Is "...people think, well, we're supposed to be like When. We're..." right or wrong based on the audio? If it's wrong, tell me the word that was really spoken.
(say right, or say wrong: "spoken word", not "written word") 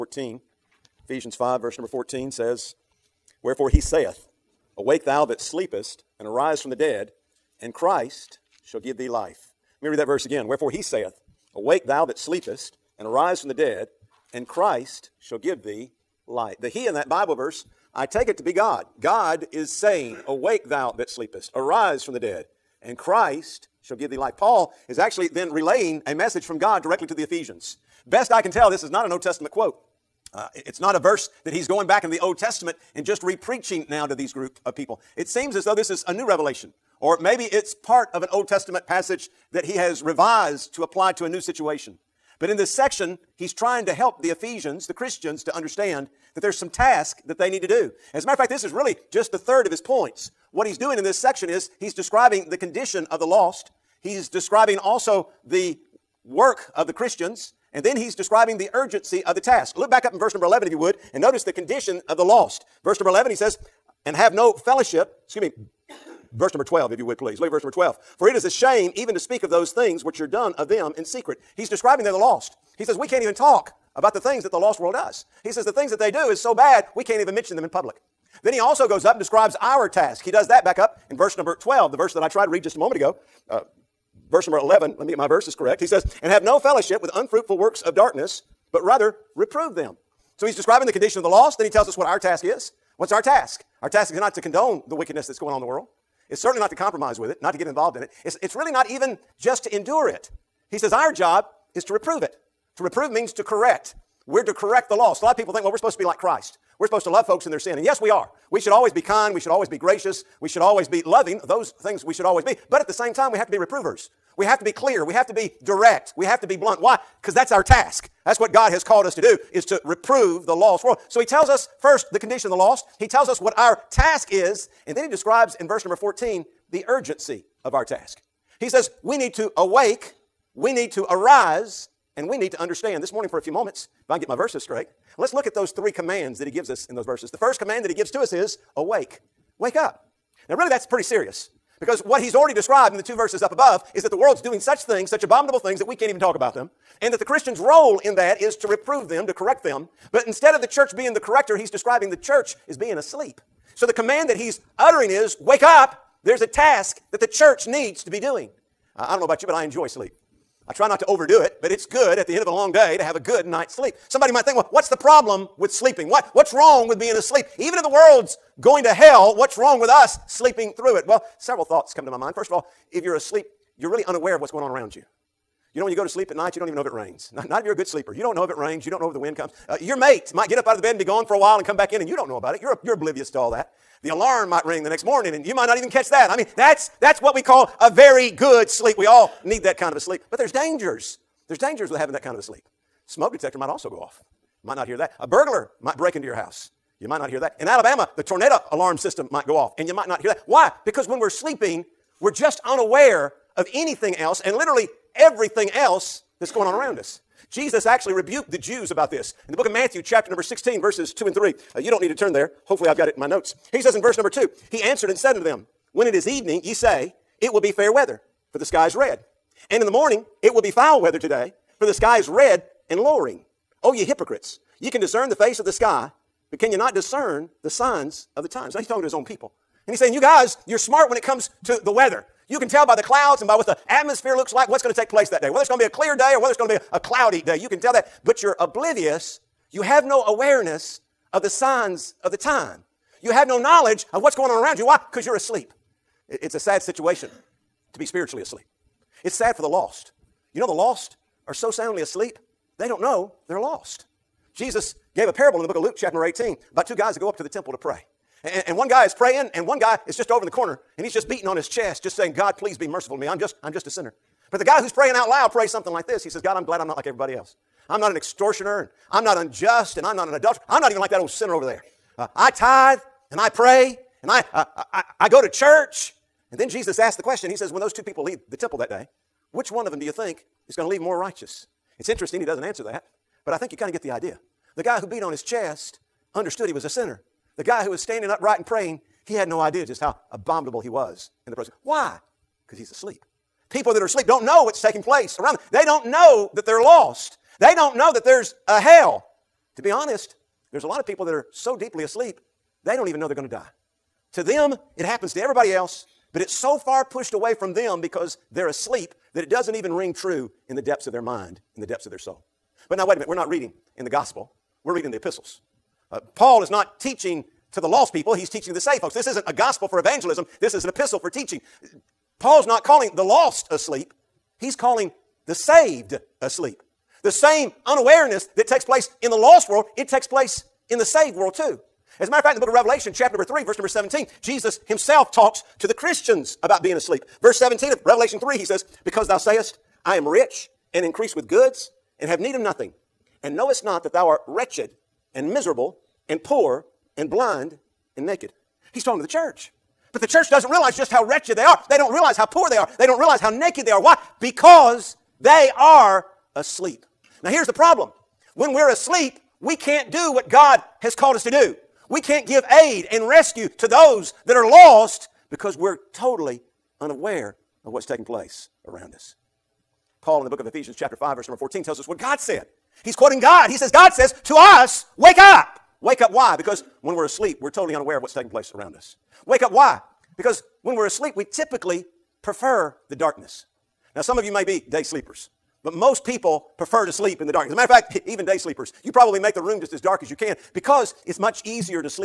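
wrong: "Christ", not "When".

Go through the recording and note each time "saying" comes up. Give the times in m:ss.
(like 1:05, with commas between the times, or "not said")
0:19, 3:49, 4:22.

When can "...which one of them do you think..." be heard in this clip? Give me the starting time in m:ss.
4:39.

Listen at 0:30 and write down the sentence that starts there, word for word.
Uh, it's not a verse that he's going back in the Old Testament and just re-preaching now to these group of people.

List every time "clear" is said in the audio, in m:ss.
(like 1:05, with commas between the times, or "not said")
1:54, 3:55.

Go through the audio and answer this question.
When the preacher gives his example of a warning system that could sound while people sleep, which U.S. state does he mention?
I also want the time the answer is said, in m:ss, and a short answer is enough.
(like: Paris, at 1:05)
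Alabama, at 3:17.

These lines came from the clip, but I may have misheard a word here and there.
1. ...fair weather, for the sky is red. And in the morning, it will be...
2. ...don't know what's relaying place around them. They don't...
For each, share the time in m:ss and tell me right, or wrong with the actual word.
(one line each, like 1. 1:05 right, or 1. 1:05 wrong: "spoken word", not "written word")
1. 3:37 right
2. 4:54 wrong: "taking", not "relaying".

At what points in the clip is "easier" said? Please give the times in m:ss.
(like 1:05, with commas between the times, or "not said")
6:31.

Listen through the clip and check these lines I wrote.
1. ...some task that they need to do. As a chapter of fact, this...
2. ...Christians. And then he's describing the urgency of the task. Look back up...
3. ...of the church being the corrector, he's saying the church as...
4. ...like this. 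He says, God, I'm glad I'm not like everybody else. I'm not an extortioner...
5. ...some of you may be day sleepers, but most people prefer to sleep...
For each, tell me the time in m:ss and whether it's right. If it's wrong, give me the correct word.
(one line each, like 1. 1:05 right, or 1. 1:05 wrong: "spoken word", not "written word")
1. 0:46 wrong: "matter", not "chapter"
2. 0:56 right
3. 2:30 wrong: "describing", not "saying"
4. 4:25 right
5. 6:24 right.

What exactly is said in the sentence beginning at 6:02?
We can't give aid and rescue to those that are lost because we're totally unaware of what's taking place around us.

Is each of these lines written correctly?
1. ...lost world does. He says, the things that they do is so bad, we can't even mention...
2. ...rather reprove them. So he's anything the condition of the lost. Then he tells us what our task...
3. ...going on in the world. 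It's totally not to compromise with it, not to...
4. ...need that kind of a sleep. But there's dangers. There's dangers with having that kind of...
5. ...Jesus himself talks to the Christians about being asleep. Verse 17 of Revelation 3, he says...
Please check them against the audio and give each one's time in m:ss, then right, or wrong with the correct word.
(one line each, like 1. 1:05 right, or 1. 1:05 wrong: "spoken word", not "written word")
1. 1:14 right
2. 1:28 wrong: "describing", not "anything"
3. 1:35 wrong: "certainly", not "totally"
4. 3:09 right
5. 5:34 right.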